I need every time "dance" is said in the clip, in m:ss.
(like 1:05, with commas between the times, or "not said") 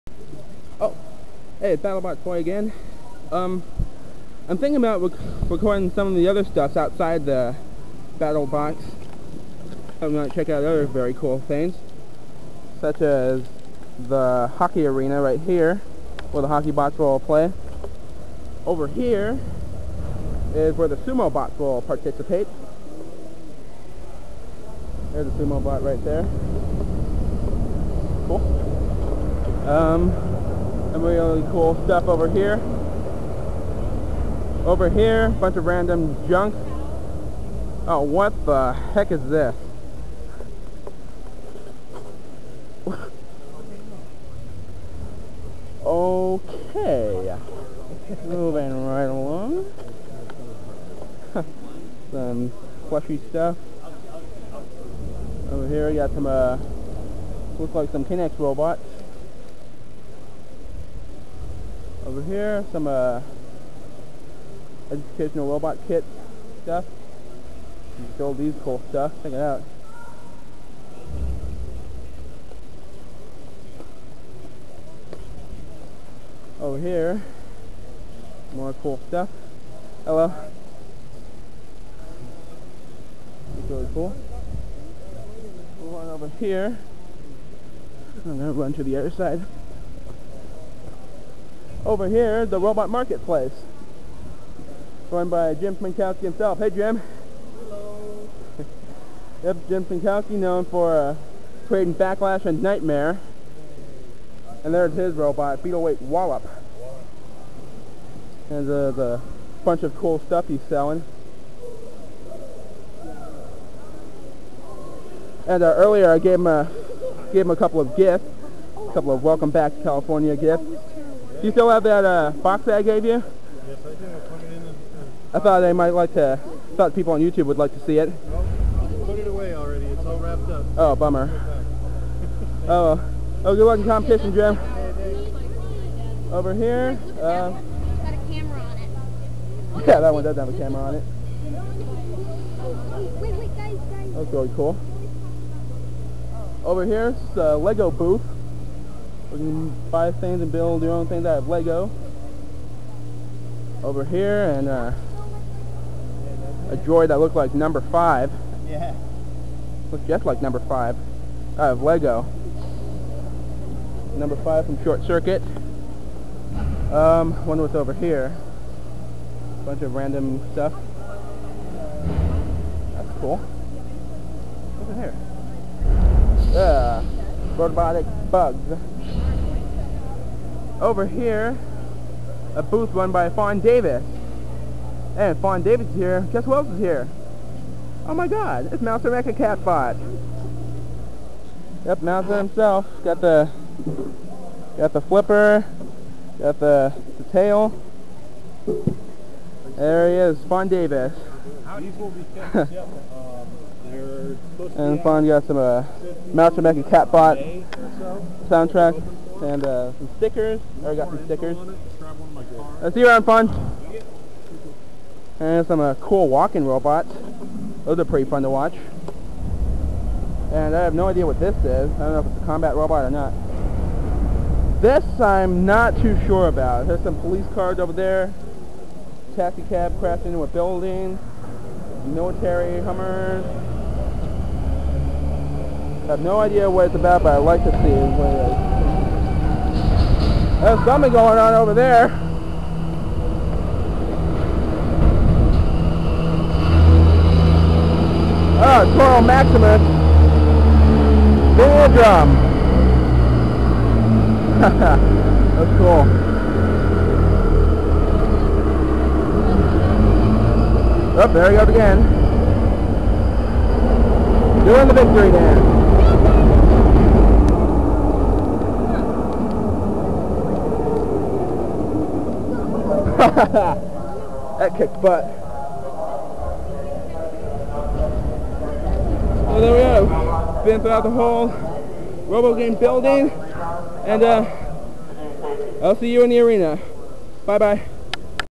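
4:25.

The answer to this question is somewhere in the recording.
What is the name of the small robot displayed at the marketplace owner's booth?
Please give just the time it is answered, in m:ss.
1:46.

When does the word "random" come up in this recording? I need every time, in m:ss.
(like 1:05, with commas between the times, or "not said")
0:35, 2:49.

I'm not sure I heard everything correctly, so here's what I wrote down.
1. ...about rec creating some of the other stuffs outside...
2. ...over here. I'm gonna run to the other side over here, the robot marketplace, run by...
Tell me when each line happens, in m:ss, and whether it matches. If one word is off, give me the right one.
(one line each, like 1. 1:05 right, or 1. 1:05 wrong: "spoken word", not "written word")
1. 0:04 wrong: "recording", not "creating"
2. 1:26 right.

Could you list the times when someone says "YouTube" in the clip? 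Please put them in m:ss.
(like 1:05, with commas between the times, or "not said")
2:07.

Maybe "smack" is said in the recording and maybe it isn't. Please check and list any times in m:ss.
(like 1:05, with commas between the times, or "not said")
not said.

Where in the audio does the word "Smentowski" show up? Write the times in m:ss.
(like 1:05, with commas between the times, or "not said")
1:35, 1:39.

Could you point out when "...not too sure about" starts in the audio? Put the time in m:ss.
3:45.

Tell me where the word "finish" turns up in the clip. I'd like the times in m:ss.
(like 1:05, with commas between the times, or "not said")
not said.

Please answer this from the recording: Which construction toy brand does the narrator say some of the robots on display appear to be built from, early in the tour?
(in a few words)
K'NEX.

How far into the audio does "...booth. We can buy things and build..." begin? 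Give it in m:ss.
2:27.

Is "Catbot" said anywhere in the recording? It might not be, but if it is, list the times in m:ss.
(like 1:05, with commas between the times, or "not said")
3:09, 3:26.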